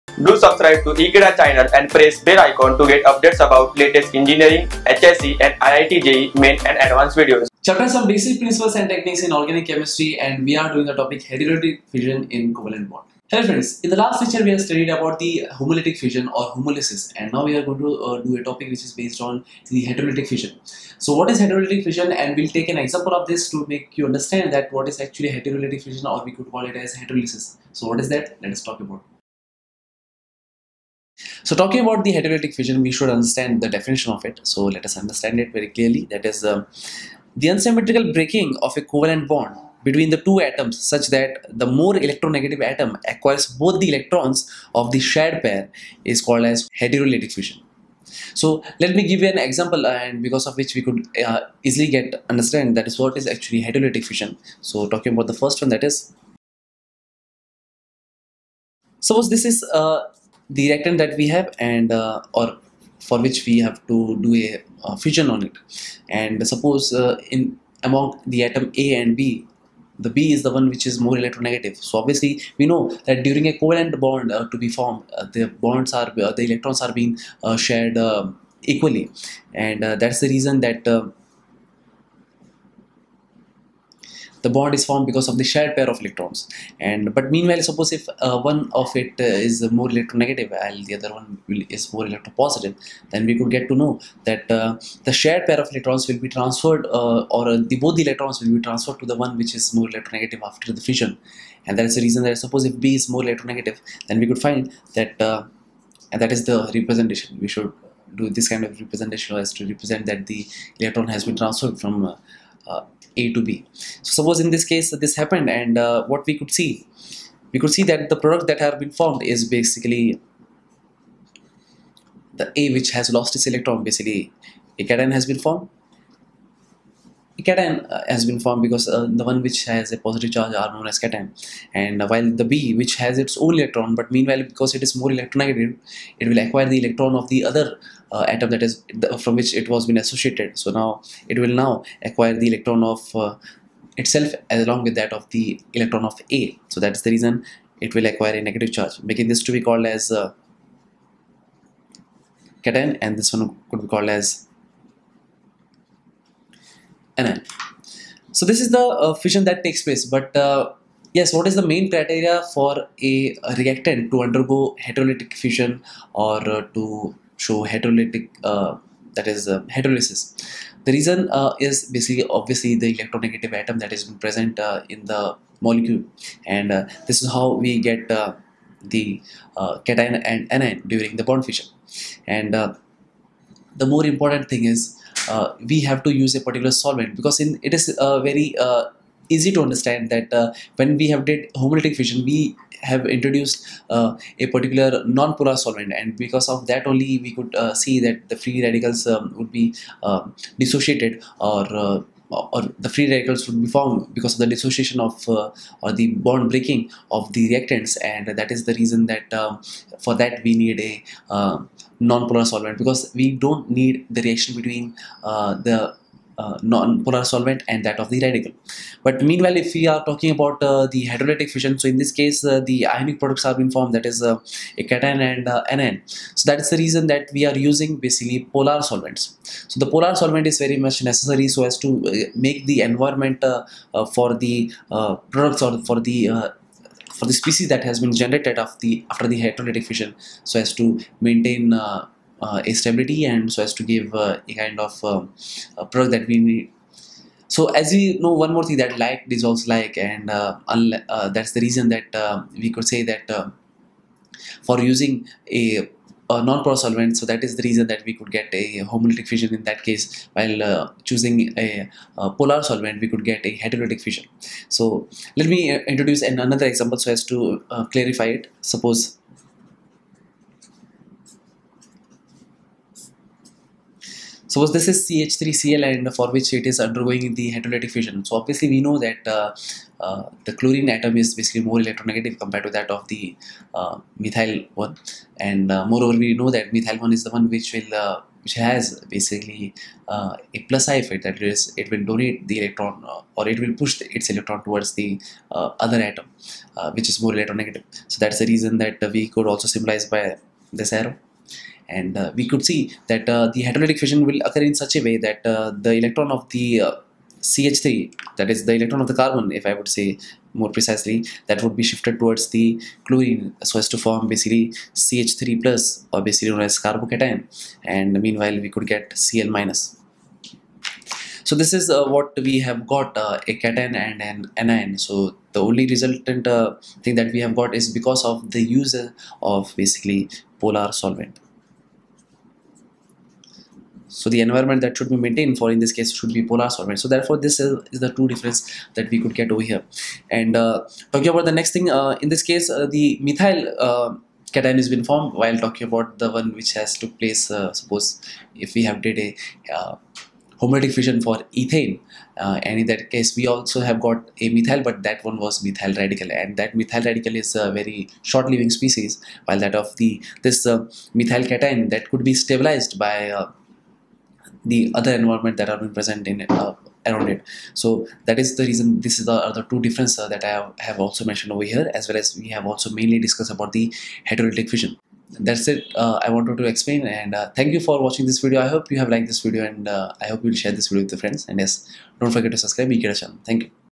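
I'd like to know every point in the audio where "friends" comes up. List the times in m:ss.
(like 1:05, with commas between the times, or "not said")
0:13, 6:21.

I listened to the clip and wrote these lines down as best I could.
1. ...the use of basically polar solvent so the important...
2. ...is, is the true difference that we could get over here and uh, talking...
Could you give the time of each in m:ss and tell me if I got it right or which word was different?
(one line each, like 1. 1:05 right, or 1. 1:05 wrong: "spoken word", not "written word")
1. 5:28 wrong: "environment", not "important"
2. 5:37 right.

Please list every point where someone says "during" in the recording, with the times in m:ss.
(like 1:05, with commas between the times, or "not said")
1:13, 3:00.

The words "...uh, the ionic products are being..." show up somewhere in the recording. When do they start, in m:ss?
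3:42.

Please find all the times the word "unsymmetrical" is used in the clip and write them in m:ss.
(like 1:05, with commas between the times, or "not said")
0:37.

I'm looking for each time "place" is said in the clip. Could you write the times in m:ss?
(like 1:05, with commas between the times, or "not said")
2:39, 5:47.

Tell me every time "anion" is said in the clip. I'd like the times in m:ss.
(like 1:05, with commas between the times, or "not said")
3:00, 3:45, 5:24.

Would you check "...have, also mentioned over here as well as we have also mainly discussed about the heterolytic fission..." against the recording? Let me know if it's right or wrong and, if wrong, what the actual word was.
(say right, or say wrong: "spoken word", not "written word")
right.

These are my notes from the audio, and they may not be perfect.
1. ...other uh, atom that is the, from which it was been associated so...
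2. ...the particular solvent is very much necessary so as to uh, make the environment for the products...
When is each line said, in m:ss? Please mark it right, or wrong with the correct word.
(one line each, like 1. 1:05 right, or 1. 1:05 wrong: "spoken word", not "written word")
1. 2:17 right
2. 3:49 wrong: "polar", not "particular".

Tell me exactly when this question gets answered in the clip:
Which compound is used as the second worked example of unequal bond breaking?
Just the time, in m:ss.
4:35.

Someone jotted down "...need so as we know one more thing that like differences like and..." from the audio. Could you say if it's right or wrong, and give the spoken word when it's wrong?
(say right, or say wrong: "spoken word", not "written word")
wrong: "dissolves", not "differences".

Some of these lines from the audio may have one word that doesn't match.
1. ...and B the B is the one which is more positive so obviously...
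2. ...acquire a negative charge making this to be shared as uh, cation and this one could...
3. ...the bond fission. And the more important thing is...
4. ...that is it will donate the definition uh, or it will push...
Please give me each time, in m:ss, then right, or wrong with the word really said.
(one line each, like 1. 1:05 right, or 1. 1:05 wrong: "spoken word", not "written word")
1. 1:09 wrong: "electronegative", not "positive"
2. 2:28 wrong: "called", not "shared"
3. 3:01 right
4. 4:51 wrong: "electron", not "definition".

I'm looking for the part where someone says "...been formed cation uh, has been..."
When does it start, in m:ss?
2:05.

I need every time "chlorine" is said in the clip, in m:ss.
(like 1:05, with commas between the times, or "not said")
4:40, 5:13.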